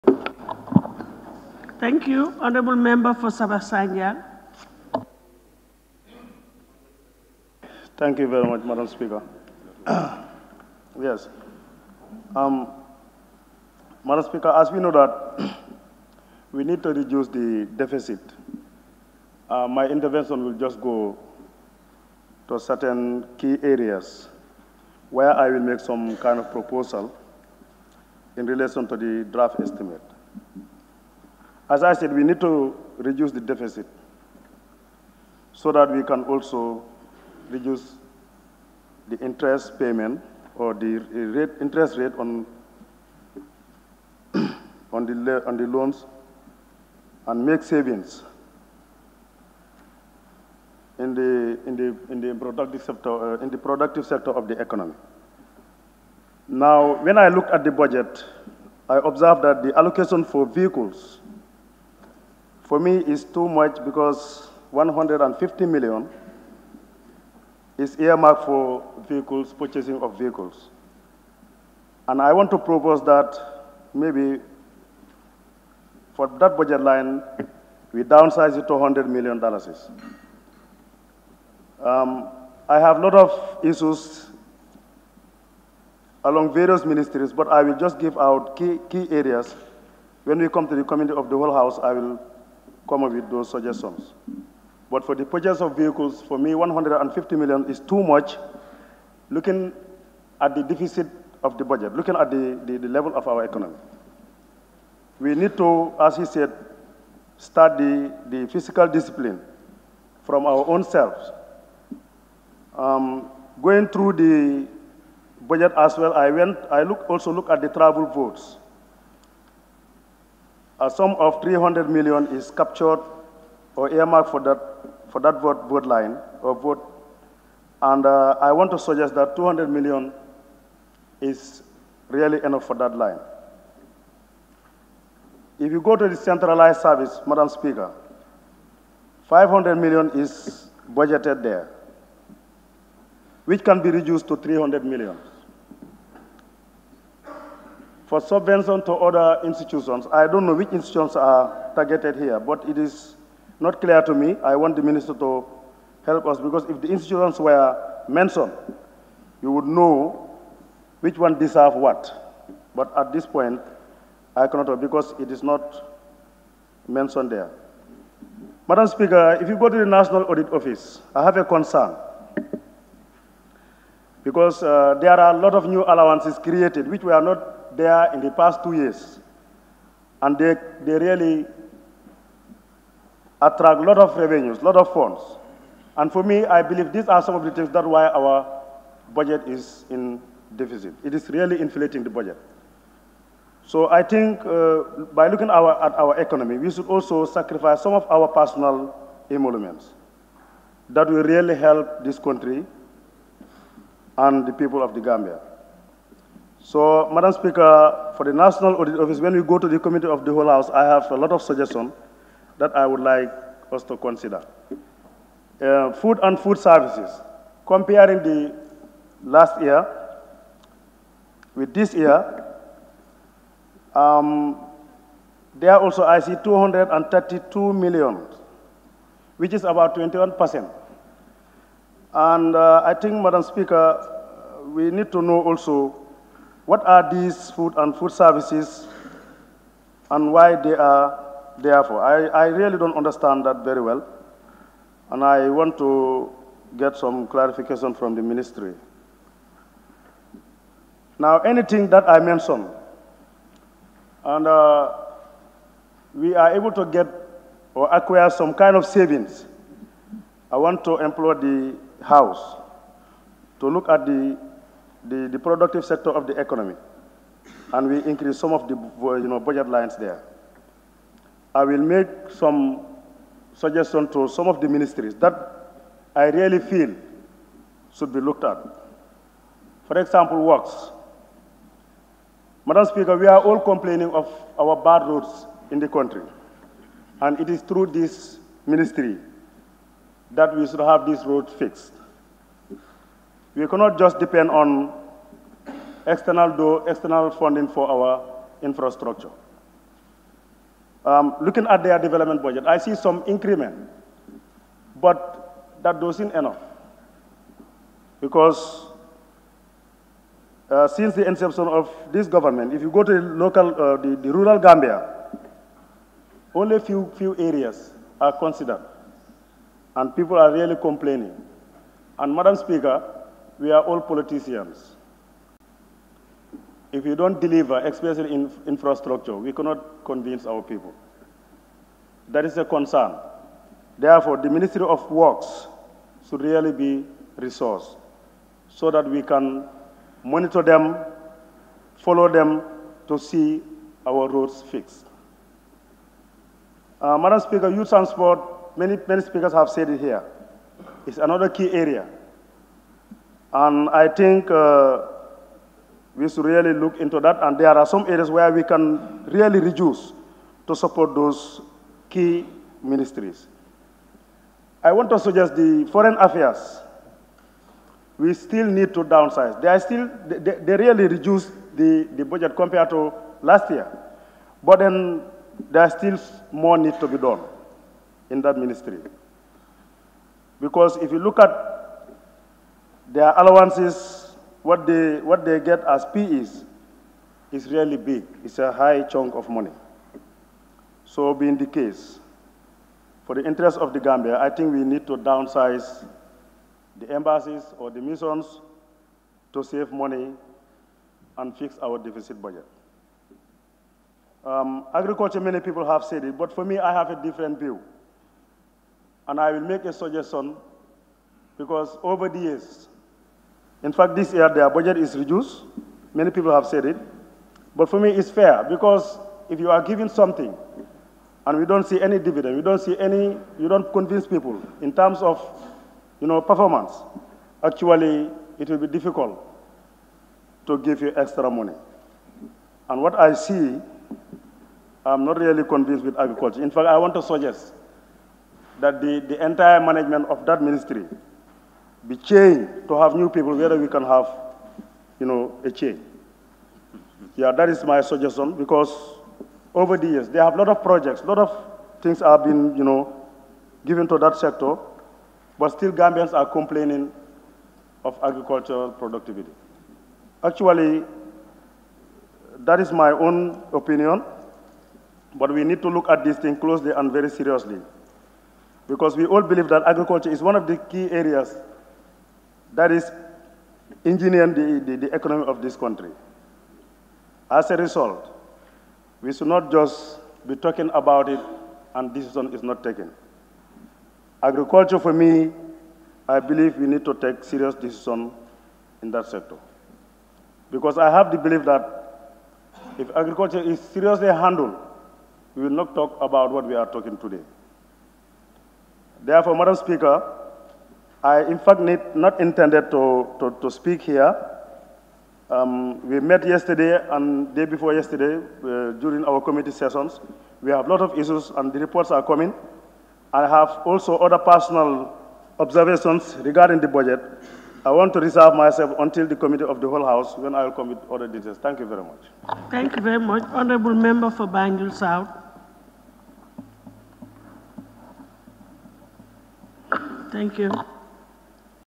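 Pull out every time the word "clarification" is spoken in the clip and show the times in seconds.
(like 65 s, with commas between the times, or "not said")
247 s.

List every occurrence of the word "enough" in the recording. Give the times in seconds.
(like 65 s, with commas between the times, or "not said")
132 s, 306 s.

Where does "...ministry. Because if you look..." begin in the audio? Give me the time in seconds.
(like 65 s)
378 s.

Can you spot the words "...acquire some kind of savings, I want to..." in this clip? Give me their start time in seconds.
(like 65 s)
257 s.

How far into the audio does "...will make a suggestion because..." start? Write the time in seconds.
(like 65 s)
409 s.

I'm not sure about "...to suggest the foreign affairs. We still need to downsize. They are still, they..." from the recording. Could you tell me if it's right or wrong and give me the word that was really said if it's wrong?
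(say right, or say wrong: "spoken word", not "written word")
right.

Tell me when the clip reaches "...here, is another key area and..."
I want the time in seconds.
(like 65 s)
349 s.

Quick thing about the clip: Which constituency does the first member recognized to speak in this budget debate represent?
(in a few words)
Sabasanya.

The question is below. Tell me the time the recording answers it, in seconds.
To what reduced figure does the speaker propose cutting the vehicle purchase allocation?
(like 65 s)
78 s.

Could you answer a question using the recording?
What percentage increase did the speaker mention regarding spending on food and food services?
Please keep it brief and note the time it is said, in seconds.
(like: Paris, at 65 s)
21%, at 229 s.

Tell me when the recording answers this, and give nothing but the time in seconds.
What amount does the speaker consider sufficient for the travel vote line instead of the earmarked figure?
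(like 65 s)
129 s.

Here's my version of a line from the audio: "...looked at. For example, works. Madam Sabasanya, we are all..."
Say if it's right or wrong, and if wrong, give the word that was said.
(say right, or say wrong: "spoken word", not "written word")
wrong: "Speaker", not "Sabasanya".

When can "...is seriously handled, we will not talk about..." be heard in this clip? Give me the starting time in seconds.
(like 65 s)
493 s.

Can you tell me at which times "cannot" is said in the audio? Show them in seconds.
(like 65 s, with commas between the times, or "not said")
164 s, 293 s, 329 s.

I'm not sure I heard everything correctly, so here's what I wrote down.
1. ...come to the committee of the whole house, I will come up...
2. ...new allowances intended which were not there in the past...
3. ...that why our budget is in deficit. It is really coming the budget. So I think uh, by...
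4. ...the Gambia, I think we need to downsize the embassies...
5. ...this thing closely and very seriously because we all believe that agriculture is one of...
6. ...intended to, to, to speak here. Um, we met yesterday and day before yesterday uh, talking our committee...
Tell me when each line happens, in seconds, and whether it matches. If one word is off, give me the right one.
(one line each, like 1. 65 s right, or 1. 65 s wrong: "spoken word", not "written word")
1. 90 s right
2. 175 s wrong: "created", not "intended"
3. 187 s wrong: "inflating", not "coming"
4. 393 s right
5. 466 s right
6. 502 s wrong: "during", not "talking".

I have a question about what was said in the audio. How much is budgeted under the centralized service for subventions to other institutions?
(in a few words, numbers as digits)
500 million.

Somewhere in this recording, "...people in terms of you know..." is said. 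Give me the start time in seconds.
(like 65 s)
424 s.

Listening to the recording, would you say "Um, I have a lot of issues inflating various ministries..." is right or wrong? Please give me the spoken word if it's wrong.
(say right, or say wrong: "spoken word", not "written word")
wrong: "along", not "inflating".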